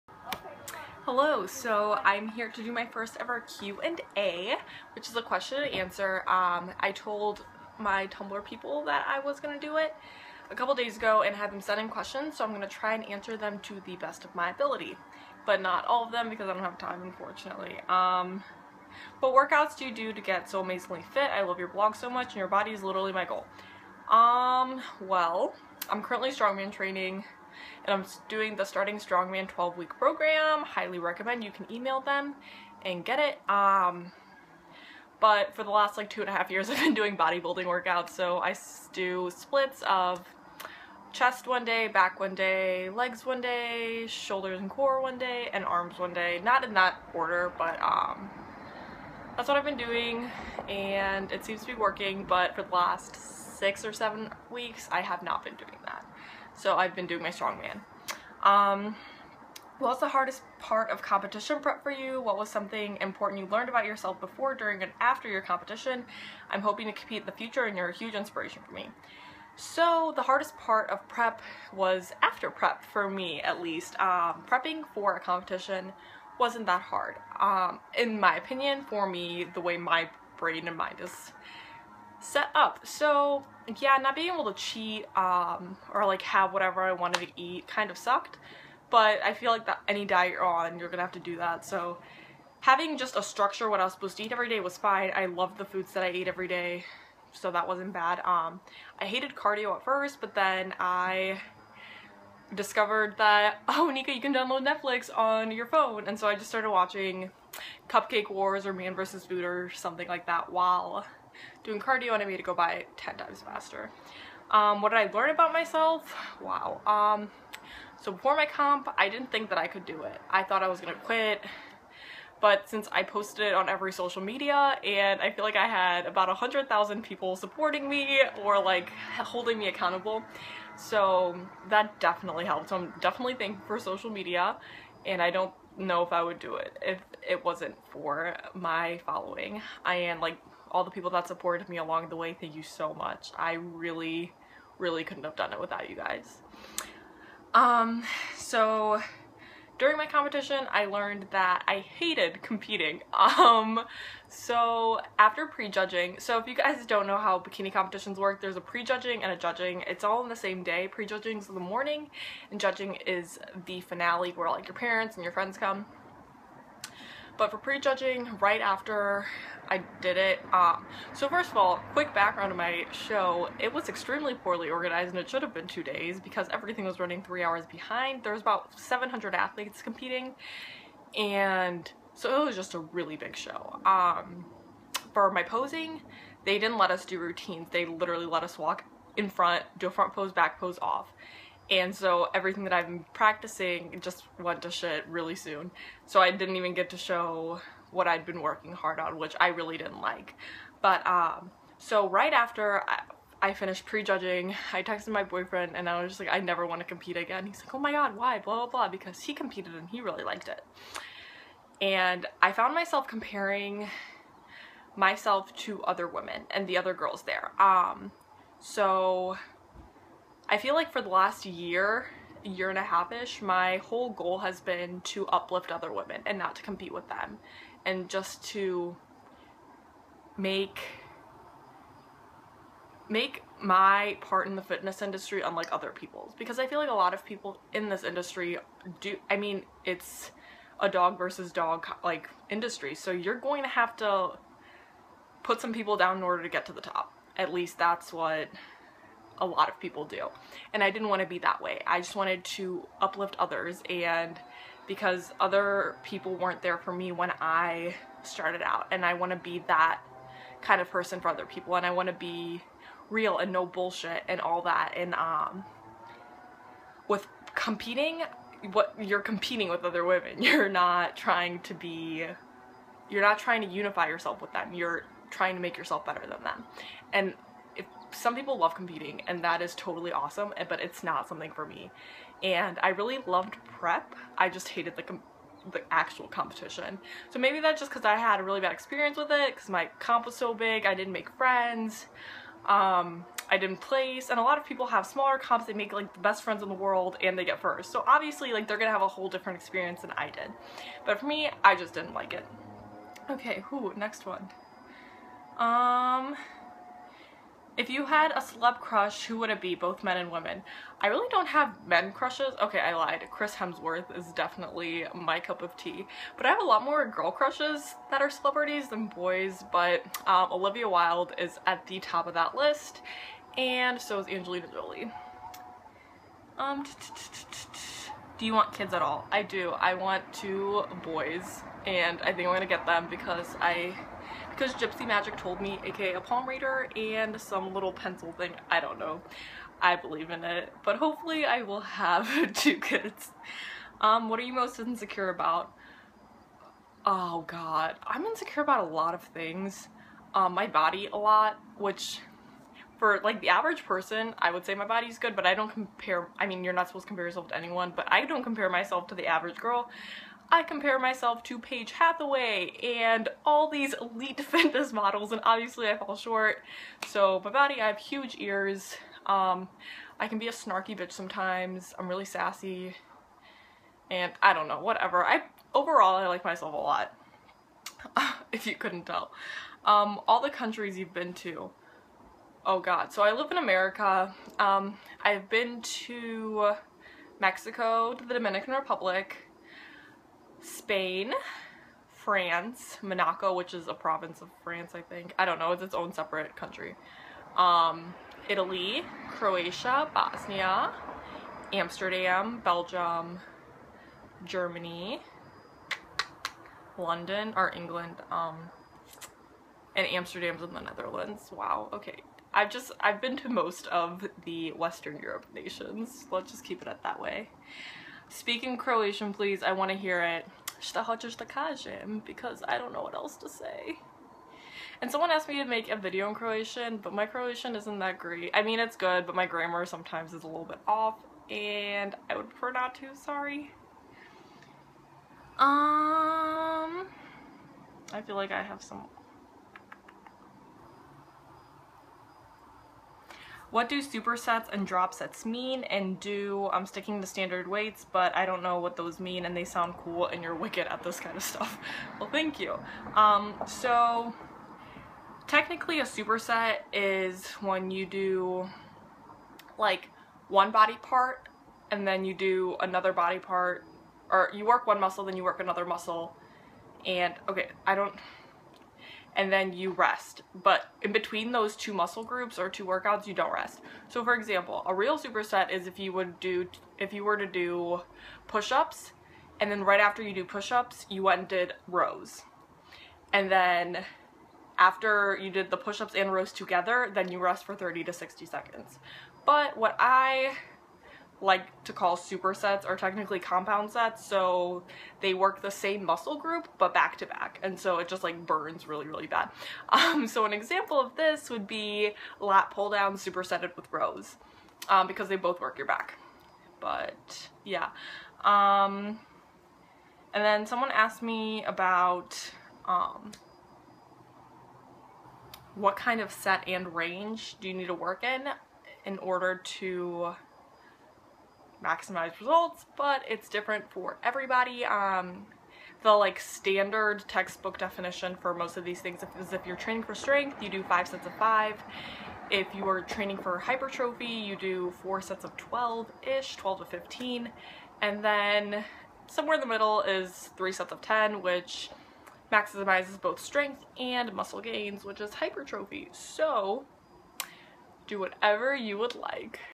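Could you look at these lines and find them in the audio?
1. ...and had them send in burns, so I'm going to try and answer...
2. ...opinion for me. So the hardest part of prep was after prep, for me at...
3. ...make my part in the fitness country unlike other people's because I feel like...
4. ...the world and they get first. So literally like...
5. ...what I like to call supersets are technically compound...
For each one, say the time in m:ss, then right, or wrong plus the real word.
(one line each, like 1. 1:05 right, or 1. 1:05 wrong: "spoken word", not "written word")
1. 0:11 wrong: "questions", not "burns"
2. 1:08 wrong: "inspiration", not "opinion"
3. 3:53 wrong: "industry", not "country"
4. 4:56 wrong: "obviously", not "literally"
5. 8:09 right.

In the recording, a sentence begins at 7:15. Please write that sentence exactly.
Um, I feel like I have some What do supersets and drop sets mean?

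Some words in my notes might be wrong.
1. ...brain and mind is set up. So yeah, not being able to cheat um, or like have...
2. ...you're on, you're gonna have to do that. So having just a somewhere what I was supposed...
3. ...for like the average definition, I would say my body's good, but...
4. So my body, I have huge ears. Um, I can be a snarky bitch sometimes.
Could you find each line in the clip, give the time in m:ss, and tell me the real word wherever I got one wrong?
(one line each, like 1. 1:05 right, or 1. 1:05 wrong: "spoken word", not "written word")
1. 1:20 right
2. 1:30 wrong: "structure", not "somewhere"
3. 5:52 wrong: "person", not "definition"
4. 6:07 right.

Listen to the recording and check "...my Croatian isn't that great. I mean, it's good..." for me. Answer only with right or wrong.
right.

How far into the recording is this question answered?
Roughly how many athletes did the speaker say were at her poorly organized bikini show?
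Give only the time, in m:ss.
2:58.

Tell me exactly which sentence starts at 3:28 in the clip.
Blah, blah, blah, because he competed and he really liked it.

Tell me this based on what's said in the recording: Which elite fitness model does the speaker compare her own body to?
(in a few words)
Paige Hathaway.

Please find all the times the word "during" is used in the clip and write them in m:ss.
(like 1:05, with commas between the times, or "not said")
1:04, 2:29.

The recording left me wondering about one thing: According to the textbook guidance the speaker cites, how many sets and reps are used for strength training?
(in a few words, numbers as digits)
5 sets of 5.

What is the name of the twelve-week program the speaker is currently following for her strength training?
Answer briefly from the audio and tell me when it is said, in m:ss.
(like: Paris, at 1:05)
Starting Strongman, at 0:28.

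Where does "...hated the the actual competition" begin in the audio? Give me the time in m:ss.
4:44.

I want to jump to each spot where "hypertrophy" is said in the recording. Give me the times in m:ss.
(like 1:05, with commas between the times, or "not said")
8:53, 9:05.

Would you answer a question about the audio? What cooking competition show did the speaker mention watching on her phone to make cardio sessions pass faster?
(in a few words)
Cupcake Wars.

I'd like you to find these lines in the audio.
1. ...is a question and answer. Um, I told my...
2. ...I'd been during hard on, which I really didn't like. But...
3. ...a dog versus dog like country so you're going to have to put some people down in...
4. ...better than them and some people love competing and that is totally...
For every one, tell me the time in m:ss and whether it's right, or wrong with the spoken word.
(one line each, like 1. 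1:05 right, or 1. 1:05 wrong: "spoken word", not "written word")
1. 0:05 right
2. 3:18 wrong: "working", not "during"
3. 4:00 wrong: "industry", not "country"
4. 4:36 right.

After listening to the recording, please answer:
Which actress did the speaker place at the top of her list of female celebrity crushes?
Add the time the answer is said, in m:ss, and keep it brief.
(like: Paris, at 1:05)
Olivia Wilde, at 5:20.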